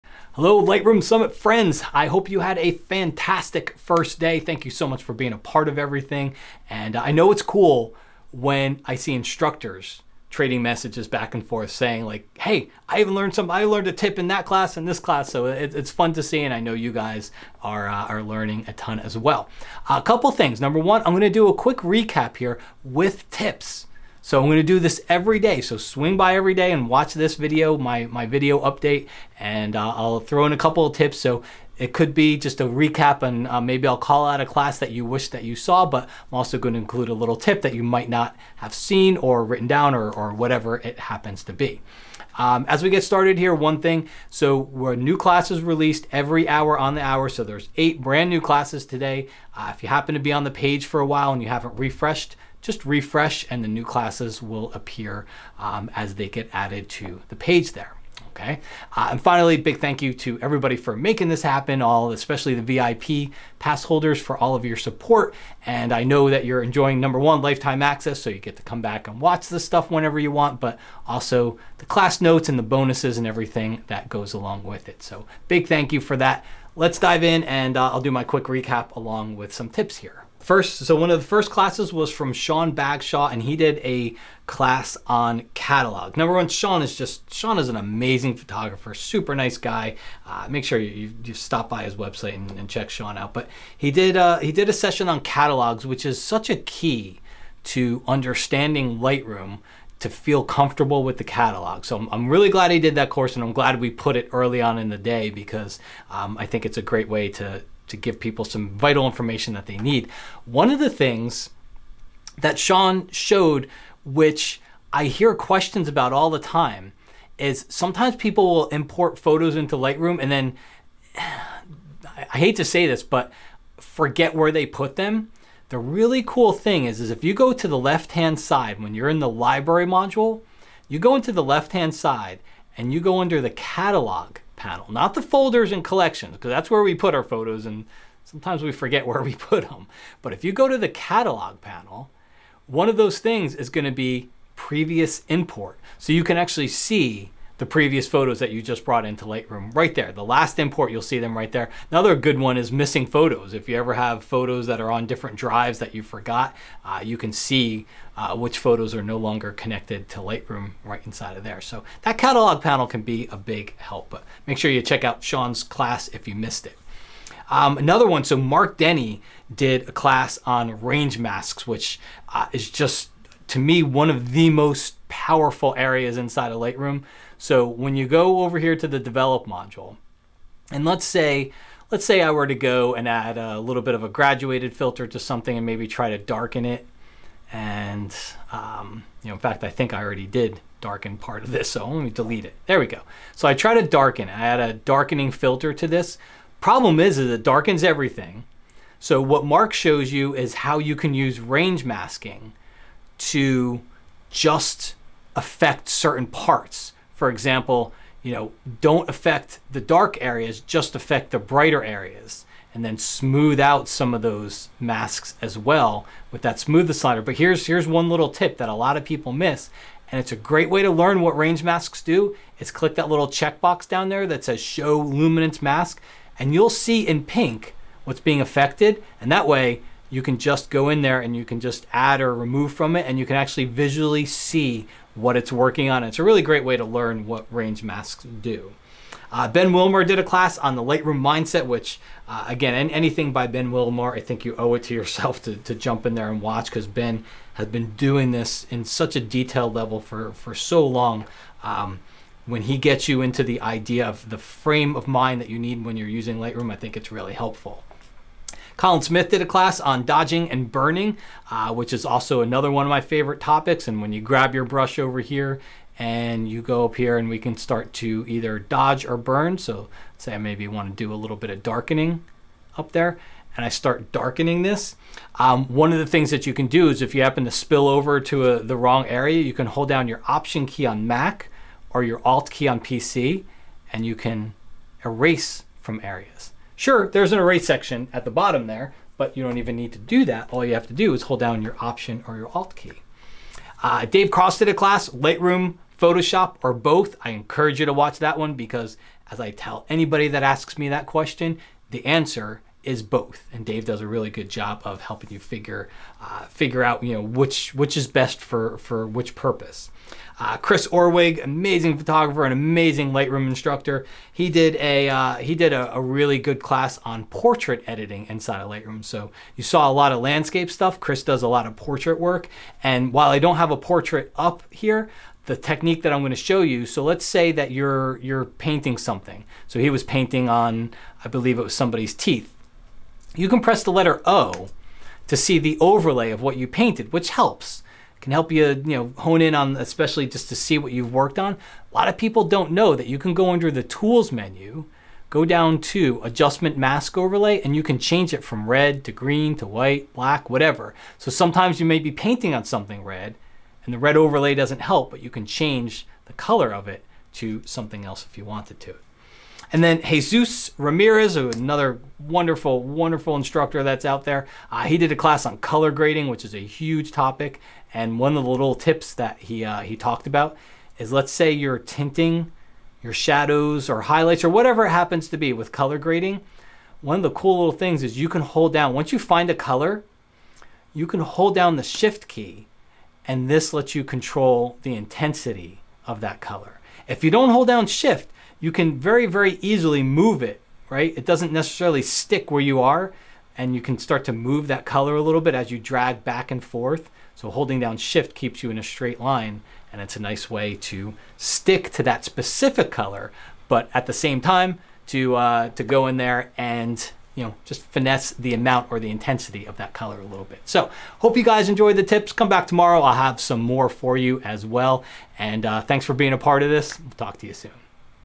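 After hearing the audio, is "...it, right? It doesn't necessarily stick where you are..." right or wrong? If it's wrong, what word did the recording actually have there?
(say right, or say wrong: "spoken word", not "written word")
right.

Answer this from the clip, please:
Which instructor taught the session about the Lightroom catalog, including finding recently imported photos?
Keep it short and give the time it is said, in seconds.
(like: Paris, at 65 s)
Sean Bagshaw, at 82 s.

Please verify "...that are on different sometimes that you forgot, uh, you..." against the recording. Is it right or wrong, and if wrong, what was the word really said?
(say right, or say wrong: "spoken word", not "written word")
wrong: "drives", not "sometimes".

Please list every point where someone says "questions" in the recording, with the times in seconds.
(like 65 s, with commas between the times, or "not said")
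115 s, 301 s.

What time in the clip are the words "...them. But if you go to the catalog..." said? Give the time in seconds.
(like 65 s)
139 s.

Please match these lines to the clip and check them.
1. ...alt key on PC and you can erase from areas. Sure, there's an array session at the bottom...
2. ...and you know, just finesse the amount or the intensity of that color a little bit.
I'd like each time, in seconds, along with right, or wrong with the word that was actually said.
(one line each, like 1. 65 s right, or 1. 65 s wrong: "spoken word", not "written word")
1. 282 s wrong: "section", not "session"
2. 406 s right.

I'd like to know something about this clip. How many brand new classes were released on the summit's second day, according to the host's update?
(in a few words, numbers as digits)
8.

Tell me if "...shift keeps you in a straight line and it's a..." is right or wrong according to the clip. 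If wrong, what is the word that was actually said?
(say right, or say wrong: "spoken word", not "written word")
right.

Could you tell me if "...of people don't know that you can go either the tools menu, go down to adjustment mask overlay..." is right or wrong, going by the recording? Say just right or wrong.
wrong.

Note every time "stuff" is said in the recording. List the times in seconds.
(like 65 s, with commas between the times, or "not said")
69 s, 320 s.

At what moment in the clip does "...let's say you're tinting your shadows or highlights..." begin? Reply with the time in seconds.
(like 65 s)
371 s.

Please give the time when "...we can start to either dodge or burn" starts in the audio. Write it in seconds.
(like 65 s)
267 s.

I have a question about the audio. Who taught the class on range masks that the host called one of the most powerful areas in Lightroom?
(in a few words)
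Mark Denney.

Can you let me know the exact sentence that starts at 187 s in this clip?
And, um, you know, in fact, I think I already did darken part of this.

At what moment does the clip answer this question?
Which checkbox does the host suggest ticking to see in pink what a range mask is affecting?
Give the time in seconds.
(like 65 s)
224 s.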